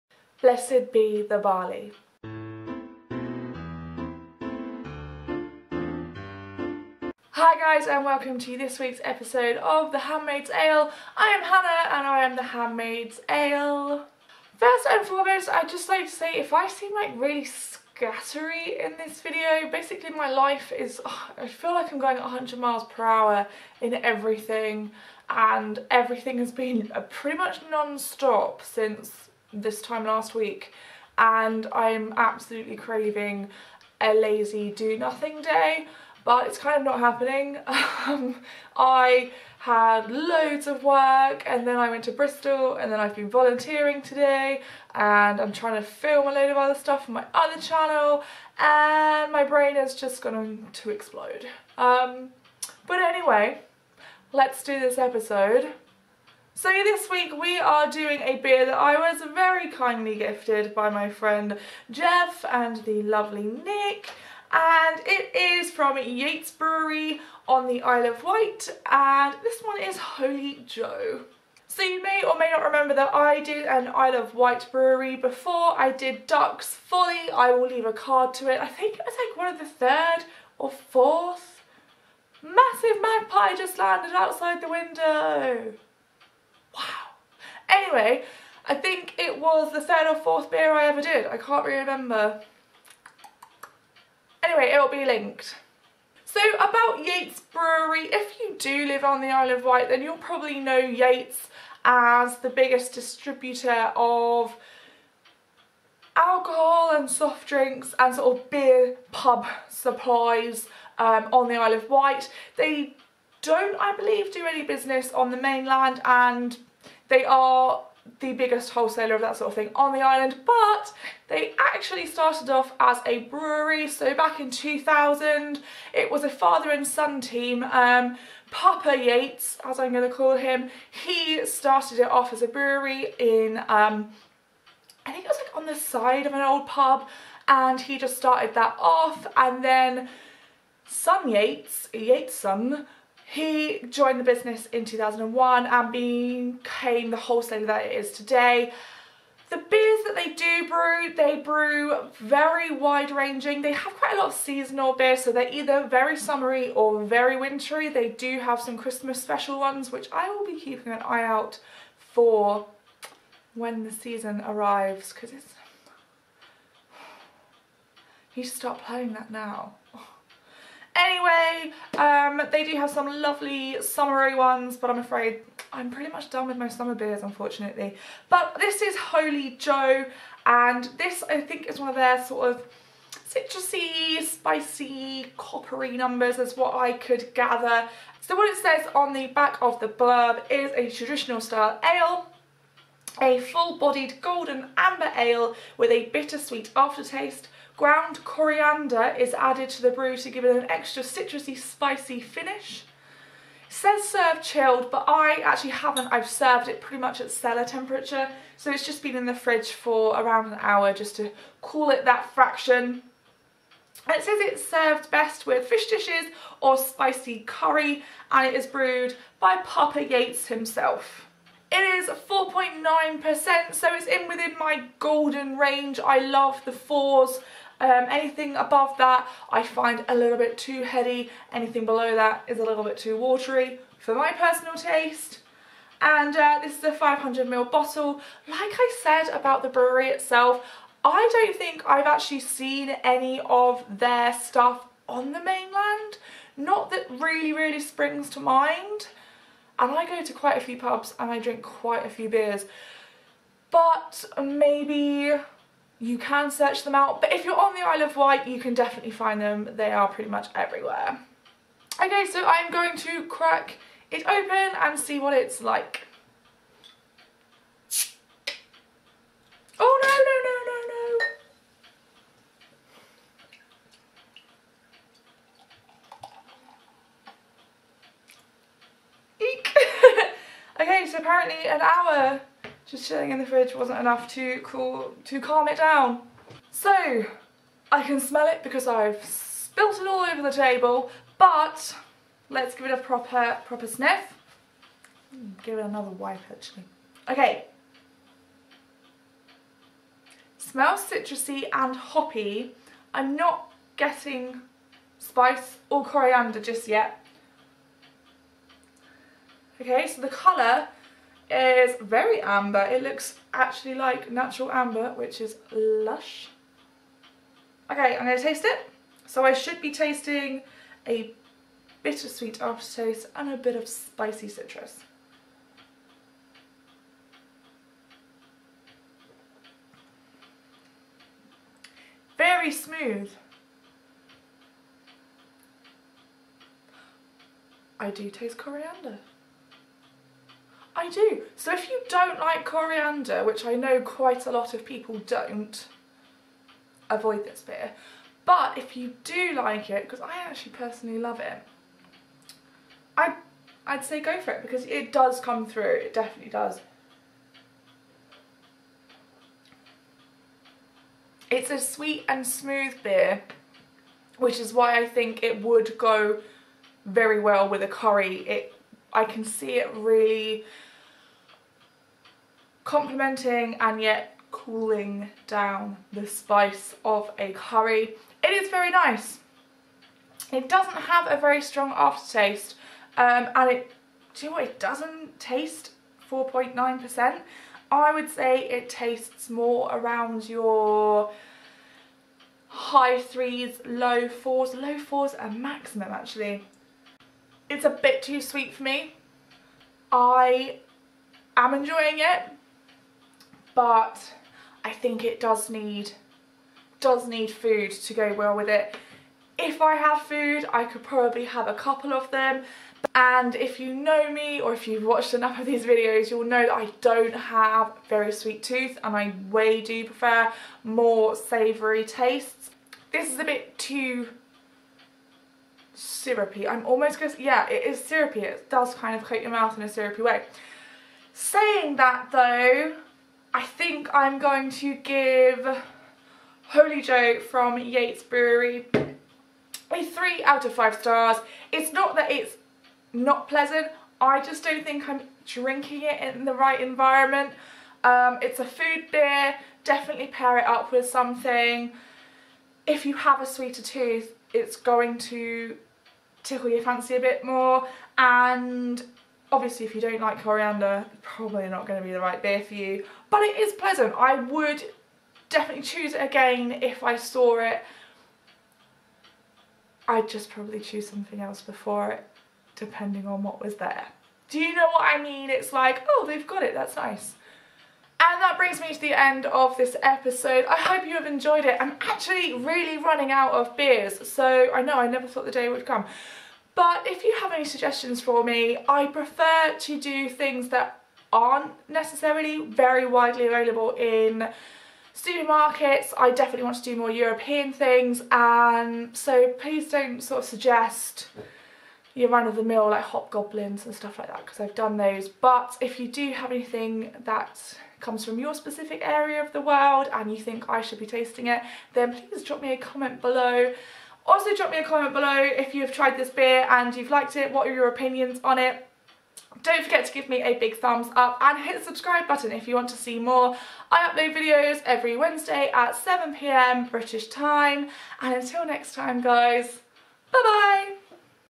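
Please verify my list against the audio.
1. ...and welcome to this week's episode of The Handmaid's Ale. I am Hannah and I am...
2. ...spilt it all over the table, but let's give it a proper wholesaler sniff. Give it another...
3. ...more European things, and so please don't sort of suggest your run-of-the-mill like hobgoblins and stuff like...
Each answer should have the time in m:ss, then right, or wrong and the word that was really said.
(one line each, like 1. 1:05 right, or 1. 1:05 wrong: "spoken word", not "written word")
1. 0:07 right
2. 4:49 wrong: "proper", not "wholesaler"
3. 8:16 right.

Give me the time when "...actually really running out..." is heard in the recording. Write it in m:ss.
8:02.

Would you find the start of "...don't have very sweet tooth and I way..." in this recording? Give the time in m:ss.
6:56.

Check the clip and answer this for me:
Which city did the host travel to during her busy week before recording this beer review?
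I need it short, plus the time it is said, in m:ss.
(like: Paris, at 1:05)
Bristol, at 0:42.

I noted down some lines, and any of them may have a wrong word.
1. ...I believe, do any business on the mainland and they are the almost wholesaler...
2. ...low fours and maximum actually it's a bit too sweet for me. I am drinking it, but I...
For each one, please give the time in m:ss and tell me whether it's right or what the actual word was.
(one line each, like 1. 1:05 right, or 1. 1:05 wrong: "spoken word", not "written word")
1. 1:53 wrong: "biggest", not "almost"
2. 6:34 wrong: "enjoying", not "drinking".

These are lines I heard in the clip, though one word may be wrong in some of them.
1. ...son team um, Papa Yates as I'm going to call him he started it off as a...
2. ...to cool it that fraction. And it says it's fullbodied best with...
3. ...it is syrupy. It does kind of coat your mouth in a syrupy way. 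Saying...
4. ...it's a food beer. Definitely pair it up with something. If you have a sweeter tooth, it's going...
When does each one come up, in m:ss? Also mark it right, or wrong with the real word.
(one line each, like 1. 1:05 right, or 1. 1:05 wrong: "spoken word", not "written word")
1. 2:06 right
2. 3:31 wrong: "served", not "fullbodied"
3. 7:07 right
4. 7:28 right.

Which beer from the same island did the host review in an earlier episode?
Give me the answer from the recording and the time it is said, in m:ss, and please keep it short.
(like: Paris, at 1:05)
Ducks Folly, at 1:16.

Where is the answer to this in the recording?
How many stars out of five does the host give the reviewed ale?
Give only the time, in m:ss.
7:20.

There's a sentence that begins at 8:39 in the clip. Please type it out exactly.
Don't forget to give me a big thumbs up and hit the subscribe button if you want to see more.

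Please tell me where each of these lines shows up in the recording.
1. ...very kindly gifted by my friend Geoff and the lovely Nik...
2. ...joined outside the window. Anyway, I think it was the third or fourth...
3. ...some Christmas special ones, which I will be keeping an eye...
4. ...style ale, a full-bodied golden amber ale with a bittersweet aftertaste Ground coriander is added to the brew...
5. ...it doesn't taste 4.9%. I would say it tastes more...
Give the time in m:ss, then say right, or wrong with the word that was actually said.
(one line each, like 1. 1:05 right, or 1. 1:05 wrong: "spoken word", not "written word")
1. 0:59 right
2. 1:23 wrong: "landed", not "joined"
3. 2:38 right
4. 3:11 right
5. 6:24 right.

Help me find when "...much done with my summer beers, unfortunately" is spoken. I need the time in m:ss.
2:56.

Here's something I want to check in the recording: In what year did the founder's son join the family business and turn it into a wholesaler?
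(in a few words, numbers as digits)
2001.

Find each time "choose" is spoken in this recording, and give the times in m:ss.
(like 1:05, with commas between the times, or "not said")
7:45, 7:50.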